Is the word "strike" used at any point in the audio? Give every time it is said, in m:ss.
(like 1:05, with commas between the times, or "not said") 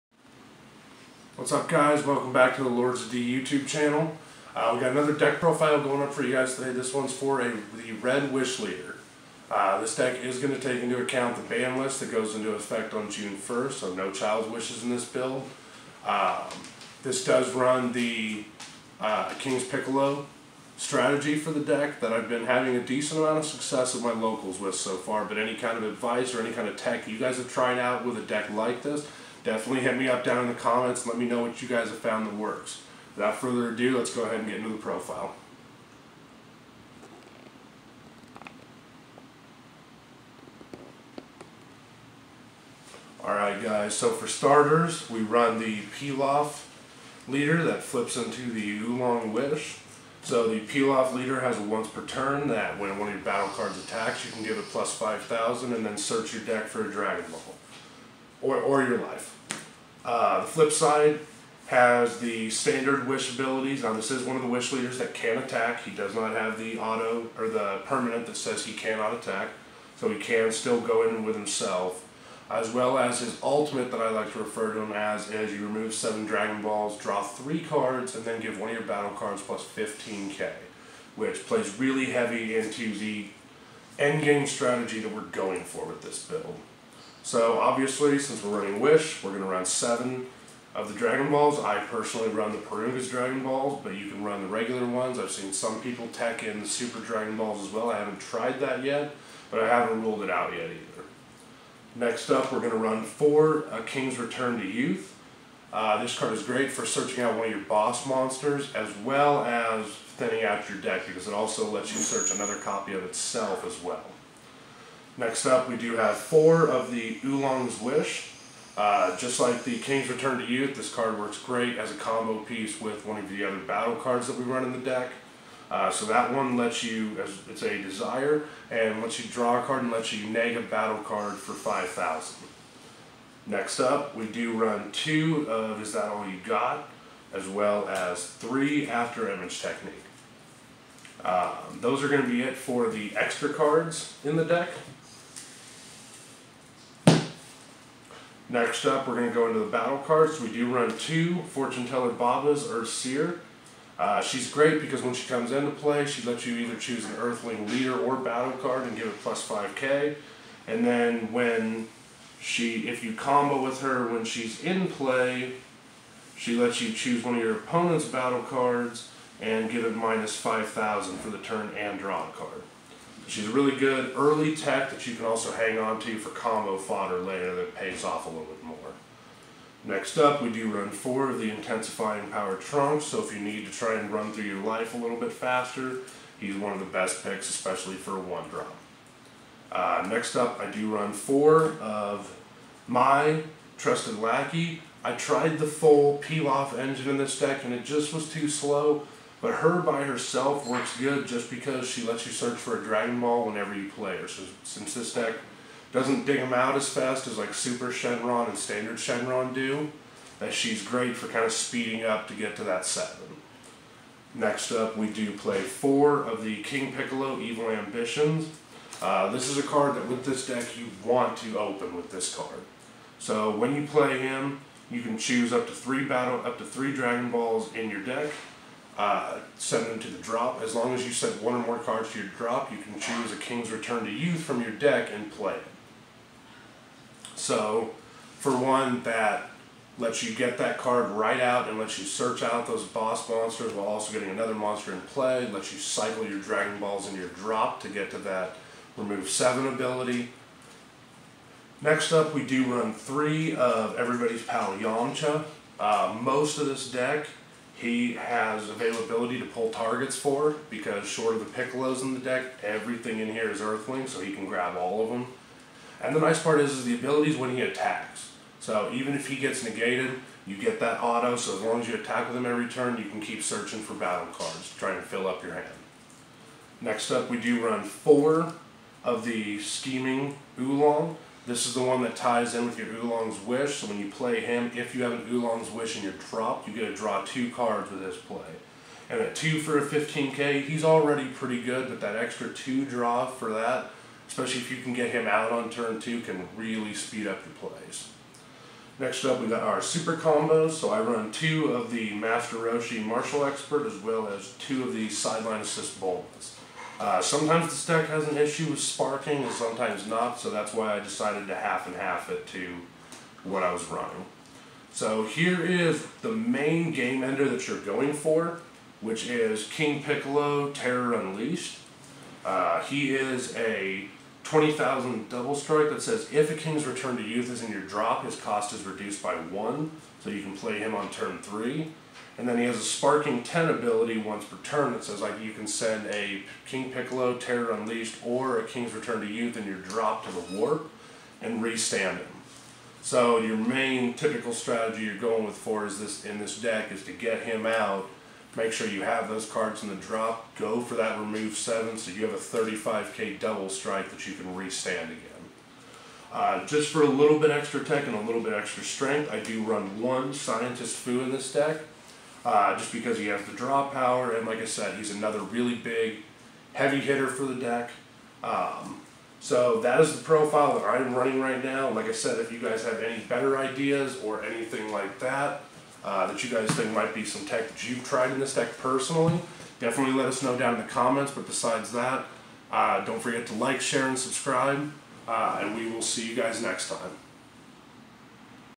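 5:25, 5:53.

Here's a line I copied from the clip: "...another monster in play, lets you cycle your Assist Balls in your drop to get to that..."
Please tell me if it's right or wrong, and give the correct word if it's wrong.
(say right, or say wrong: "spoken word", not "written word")
wrong: "Dragon", not "Assist".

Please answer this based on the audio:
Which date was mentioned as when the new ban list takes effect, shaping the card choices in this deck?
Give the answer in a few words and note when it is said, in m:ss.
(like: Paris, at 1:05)
June 1st, at 0:13.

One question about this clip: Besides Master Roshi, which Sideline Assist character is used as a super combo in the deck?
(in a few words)
Bulbas.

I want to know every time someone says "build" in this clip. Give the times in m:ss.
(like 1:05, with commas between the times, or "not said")
0:15, 1:26.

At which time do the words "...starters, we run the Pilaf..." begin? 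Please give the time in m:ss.
0:44.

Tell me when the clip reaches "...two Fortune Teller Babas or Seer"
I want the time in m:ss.
2:30.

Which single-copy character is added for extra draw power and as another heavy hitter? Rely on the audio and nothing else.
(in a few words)
Scientist Foo.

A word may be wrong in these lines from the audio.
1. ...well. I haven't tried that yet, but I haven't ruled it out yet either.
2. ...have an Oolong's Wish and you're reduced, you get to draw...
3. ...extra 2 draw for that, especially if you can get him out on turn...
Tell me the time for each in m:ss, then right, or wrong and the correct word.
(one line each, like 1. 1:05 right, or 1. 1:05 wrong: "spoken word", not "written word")
1. 1:37 right
2. 4:45 wrong: "dropped", not "reduced"
3. 4:52 right.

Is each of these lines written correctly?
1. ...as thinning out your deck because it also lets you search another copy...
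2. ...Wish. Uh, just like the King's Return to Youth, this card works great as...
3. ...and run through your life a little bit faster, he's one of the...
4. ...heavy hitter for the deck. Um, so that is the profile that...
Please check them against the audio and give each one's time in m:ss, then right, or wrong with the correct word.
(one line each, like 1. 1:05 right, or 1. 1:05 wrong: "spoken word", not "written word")
1. 1:49 right
2. 1:57 right
3. 3:03 right
4. 6:06 right.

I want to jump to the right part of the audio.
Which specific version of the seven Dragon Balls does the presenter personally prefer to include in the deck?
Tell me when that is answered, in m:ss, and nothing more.
1:32.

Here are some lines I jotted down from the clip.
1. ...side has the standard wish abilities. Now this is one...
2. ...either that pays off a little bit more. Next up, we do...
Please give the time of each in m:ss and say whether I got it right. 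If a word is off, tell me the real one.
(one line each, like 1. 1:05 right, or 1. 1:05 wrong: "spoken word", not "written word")
1. 1:00 right
2. 2:57 wrong: "later", not "either".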